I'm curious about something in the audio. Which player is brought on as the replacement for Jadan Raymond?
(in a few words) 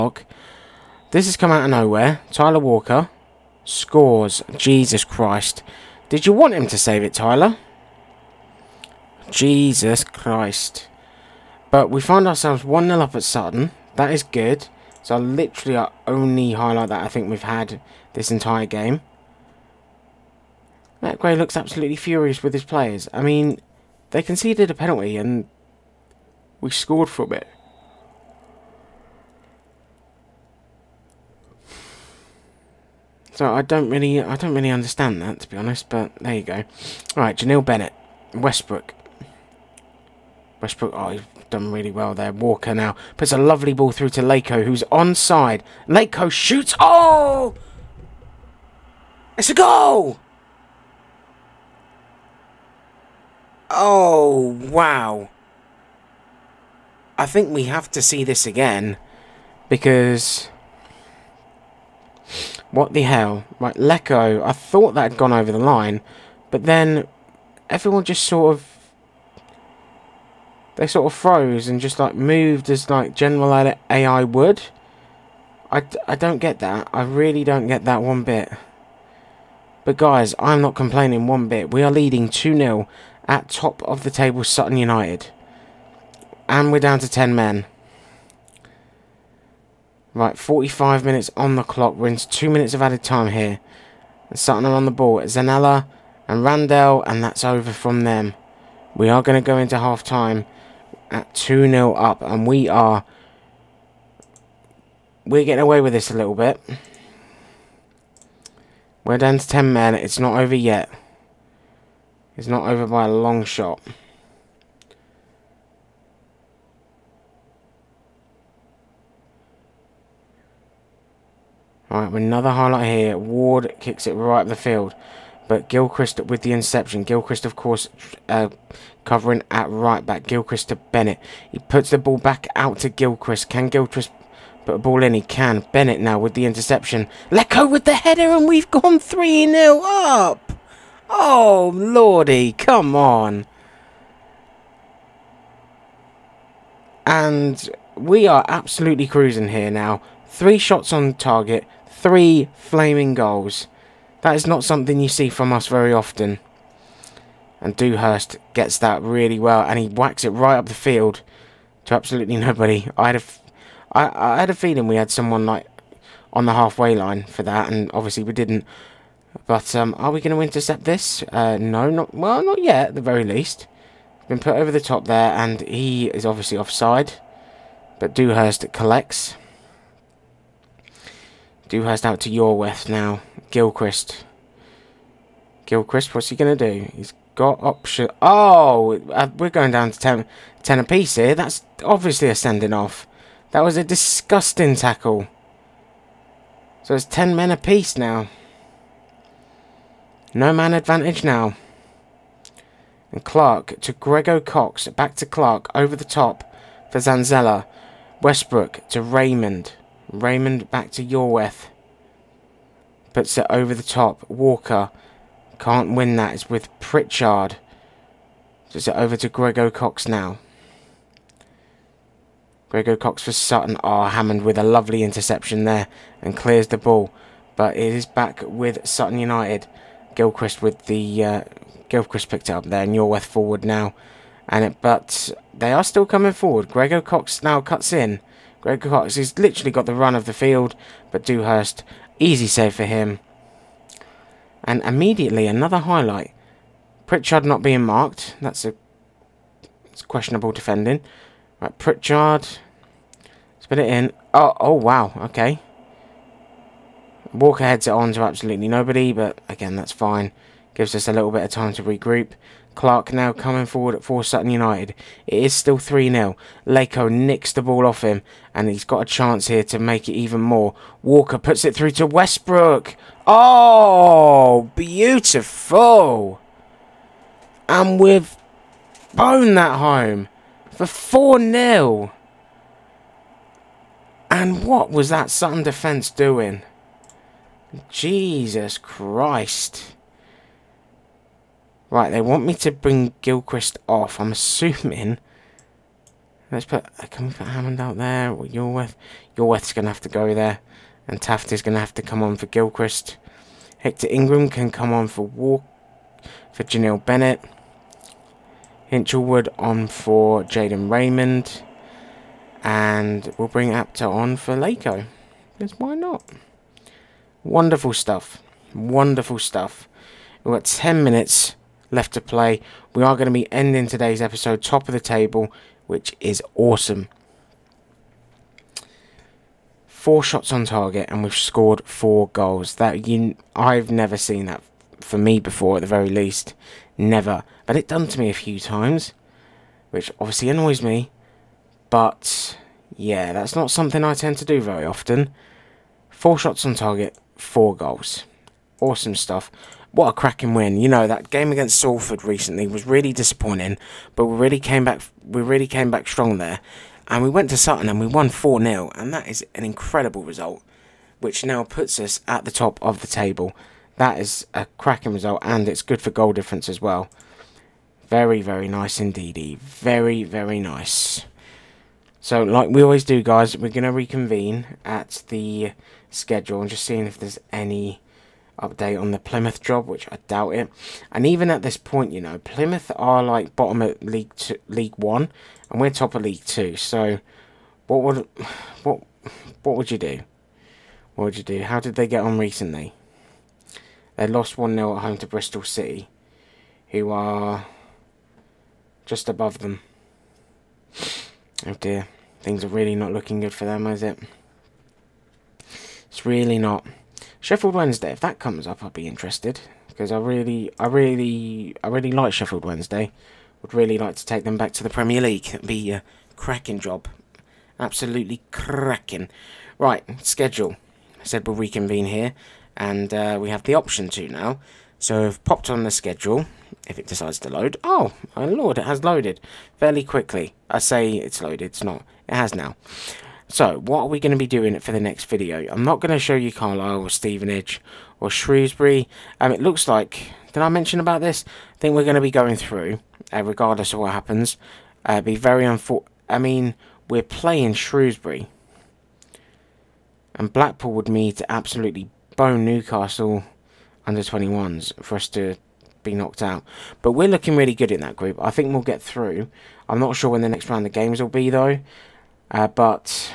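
Hinchelwood.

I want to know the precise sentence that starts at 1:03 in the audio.
Right, Lecco, I thought that had gone over the line.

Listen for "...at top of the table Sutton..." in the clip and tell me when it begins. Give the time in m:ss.
1:23.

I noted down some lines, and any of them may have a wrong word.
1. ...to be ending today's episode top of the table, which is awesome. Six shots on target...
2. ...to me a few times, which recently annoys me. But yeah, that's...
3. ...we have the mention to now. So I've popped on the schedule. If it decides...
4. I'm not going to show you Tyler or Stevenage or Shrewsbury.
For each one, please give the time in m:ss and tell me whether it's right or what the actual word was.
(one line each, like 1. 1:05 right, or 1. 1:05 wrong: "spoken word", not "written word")
1. 5:23 wrong: "Four", not "Six"
2. 5:38 wrong: "obviously", not "recently"
3. 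7:03 wrong: "option", not "mention"
4. 7:15 wrong: "Carlisle", not "Tyler".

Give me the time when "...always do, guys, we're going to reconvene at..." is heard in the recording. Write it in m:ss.
6:12.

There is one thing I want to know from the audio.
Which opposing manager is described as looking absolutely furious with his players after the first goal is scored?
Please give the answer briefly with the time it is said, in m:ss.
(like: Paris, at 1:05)
Matt Gray, at 0:21.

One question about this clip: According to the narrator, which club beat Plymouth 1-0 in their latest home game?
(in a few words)
Bristol City.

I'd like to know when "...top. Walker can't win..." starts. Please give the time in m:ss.
3:33.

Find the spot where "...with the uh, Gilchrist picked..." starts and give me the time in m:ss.
3:50.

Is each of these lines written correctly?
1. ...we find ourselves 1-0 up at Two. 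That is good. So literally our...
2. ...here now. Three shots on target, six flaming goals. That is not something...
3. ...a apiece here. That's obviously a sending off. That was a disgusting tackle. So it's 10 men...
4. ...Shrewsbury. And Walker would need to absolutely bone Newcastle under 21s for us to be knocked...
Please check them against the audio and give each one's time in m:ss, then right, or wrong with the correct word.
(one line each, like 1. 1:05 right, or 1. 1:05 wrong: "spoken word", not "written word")
1. 0:11 wrong: "Sutton", not "Two"
2. 2:29 wrong: "three", not "six"
3. 3:10 right
4. 7:27 wrong: "Blackpool", not "Walker".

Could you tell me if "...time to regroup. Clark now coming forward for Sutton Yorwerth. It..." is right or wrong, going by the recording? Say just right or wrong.
wrong.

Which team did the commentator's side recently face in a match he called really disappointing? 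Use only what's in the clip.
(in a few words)
Salford.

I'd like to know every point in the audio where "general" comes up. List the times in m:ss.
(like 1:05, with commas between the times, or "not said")
1:13.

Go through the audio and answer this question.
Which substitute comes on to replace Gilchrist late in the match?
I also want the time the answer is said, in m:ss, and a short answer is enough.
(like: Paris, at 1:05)
Taft, at 5:01.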